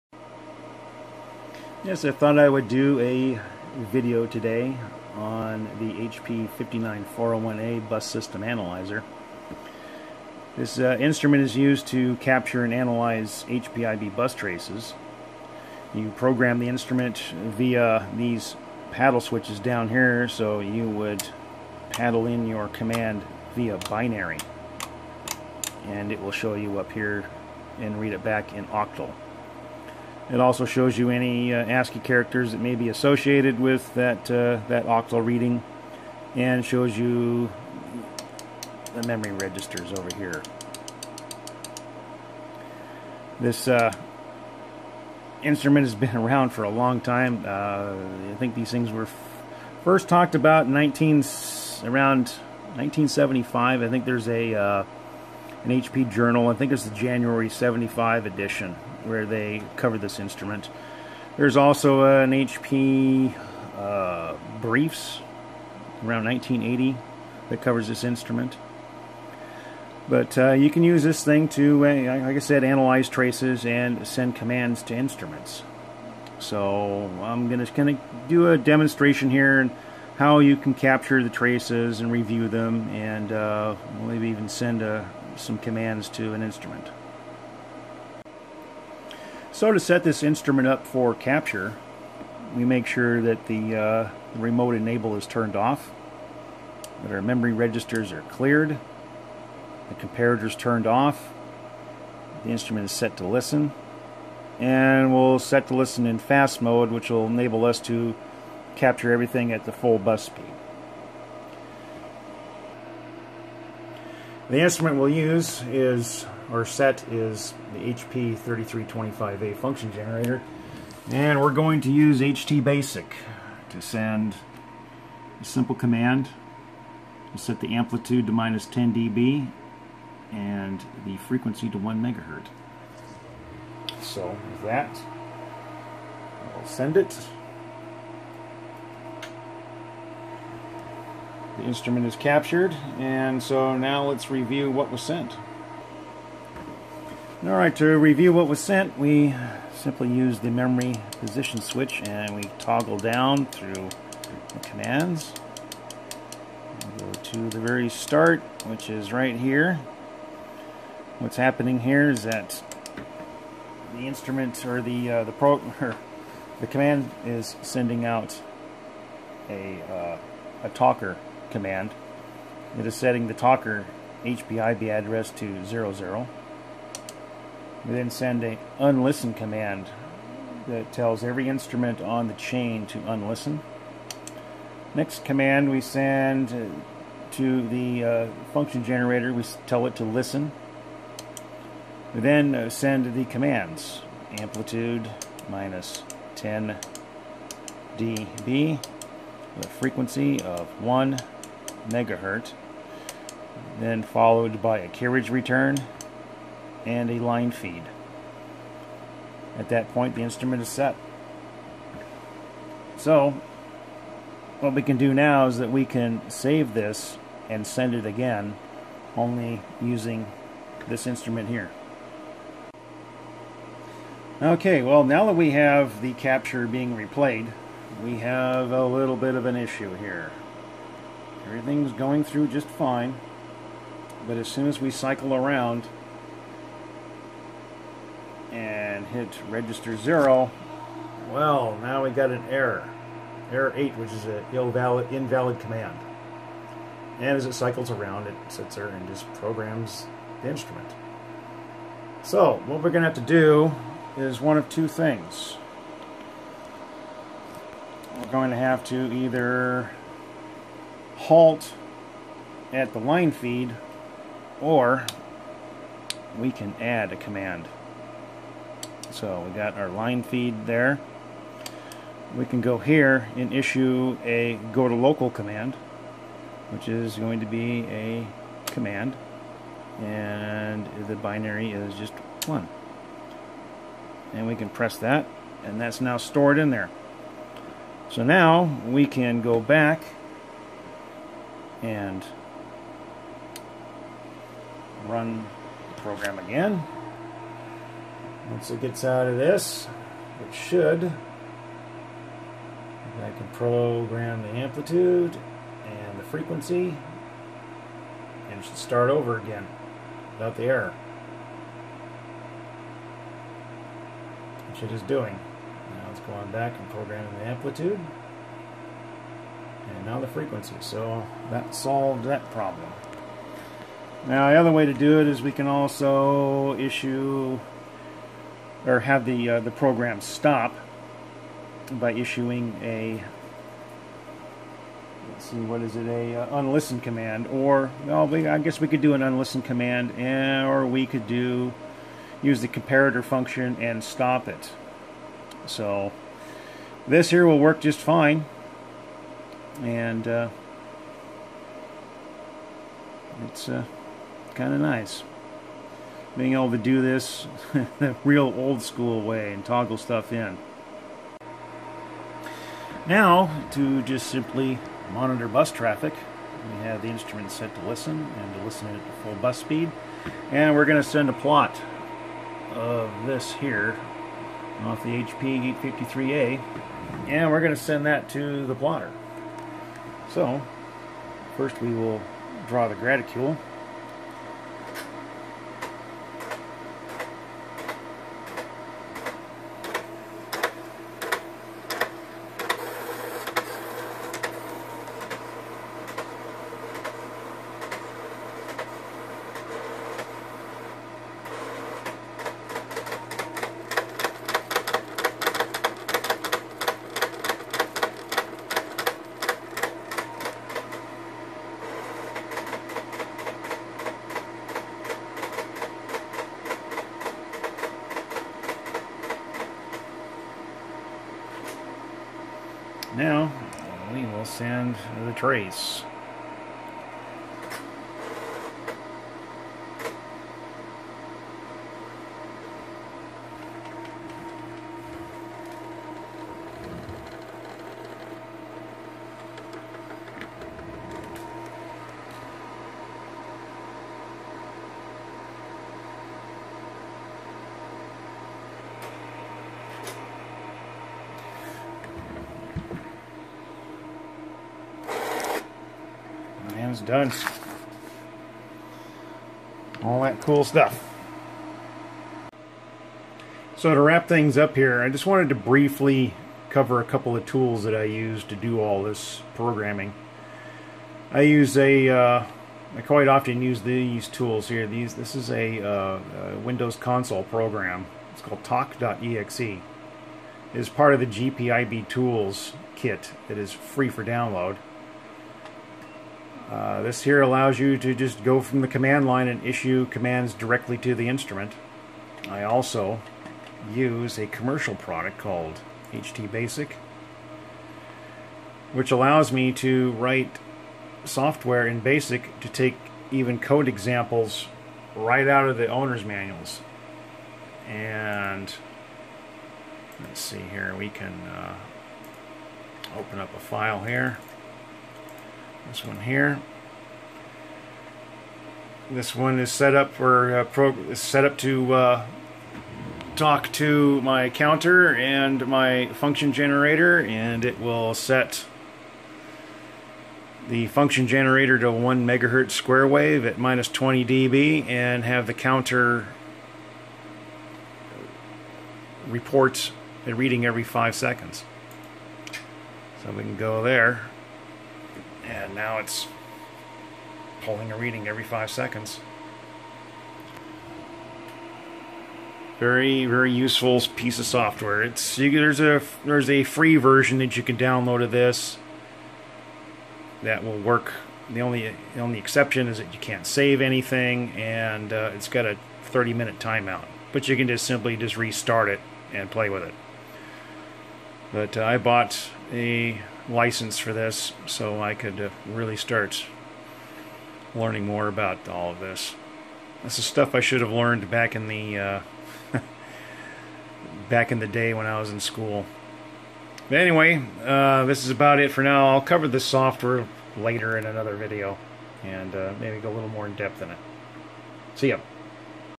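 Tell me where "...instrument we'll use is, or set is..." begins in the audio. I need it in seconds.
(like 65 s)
114 s.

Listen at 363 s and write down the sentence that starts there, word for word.
Now to just simply monitor bus traffic.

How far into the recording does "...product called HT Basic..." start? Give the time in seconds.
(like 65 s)
494 s.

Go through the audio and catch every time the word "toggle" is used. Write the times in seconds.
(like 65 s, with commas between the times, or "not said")
152 s, 359 s.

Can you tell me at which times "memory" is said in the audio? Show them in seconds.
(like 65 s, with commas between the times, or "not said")
39 s, 97 s, 150 s.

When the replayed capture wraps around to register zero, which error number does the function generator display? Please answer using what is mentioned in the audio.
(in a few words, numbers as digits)
Error 8.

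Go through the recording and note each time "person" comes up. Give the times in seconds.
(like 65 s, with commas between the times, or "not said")
not said.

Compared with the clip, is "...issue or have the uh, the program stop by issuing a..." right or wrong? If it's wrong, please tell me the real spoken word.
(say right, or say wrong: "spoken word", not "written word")
right.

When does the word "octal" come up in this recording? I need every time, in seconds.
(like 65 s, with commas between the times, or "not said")
28 s, 34 s.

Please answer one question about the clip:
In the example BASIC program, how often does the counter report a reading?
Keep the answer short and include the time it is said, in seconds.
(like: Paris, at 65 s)
every 5 seconds, at 540 s.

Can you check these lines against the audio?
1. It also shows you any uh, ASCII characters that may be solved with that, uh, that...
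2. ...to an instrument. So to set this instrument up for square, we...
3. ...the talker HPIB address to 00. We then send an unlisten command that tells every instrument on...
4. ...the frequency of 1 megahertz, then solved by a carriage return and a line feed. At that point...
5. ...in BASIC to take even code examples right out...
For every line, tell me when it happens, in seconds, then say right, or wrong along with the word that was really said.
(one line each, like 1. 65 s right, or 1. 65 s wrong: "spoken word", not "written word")
1. 30 s wrong: "associated", not "solved"
2. 86 s wrong: "capture", not "square"
3. 173 s right
4. 199 s wrong: "followed", not "solved"
5. 501 s right.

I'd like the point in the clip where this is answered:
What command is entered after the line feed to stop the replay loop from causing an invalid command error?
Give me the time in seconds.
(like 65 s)
274 s.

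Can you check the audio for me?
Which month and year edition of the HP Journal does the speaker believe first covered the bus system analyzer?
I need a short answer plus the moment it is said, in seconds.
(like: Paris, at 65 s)
January 1975, at 56 s.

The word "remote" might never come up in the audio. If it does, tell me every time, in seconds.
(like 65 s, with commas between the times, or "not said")
94 s.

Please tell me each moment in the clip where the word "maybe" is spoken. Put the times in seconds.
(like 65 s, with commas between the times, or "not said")
84 s, 592 s.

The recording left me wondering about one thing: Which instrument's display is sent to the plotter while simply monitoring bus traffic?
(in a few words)
HP 853A.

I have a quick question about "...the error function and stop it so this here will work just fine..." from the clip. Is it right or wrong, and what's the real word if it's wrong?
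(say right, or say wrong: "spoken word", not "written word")
wrong: "comparator", not "error".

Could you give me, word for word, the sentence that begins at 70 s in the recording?
But uh, you can use this thing to, uh, like I said, analyze traces and send commands to instruments.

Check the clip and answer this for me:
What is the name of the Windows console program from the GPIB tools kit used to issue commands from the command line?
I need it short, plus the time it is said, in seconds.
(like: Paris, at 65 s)
talk.exe, at 478 s.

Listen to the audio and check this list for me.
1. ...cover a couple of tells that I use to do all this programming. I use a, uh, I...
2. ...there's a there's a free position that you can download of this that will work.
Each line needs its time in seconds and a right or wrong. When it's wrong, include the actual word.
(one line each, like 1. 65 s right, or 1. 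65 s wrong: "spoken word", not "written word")
1. 466 s wrong: "tools", not "tells"
2. 555 s wrong: "version", not "position".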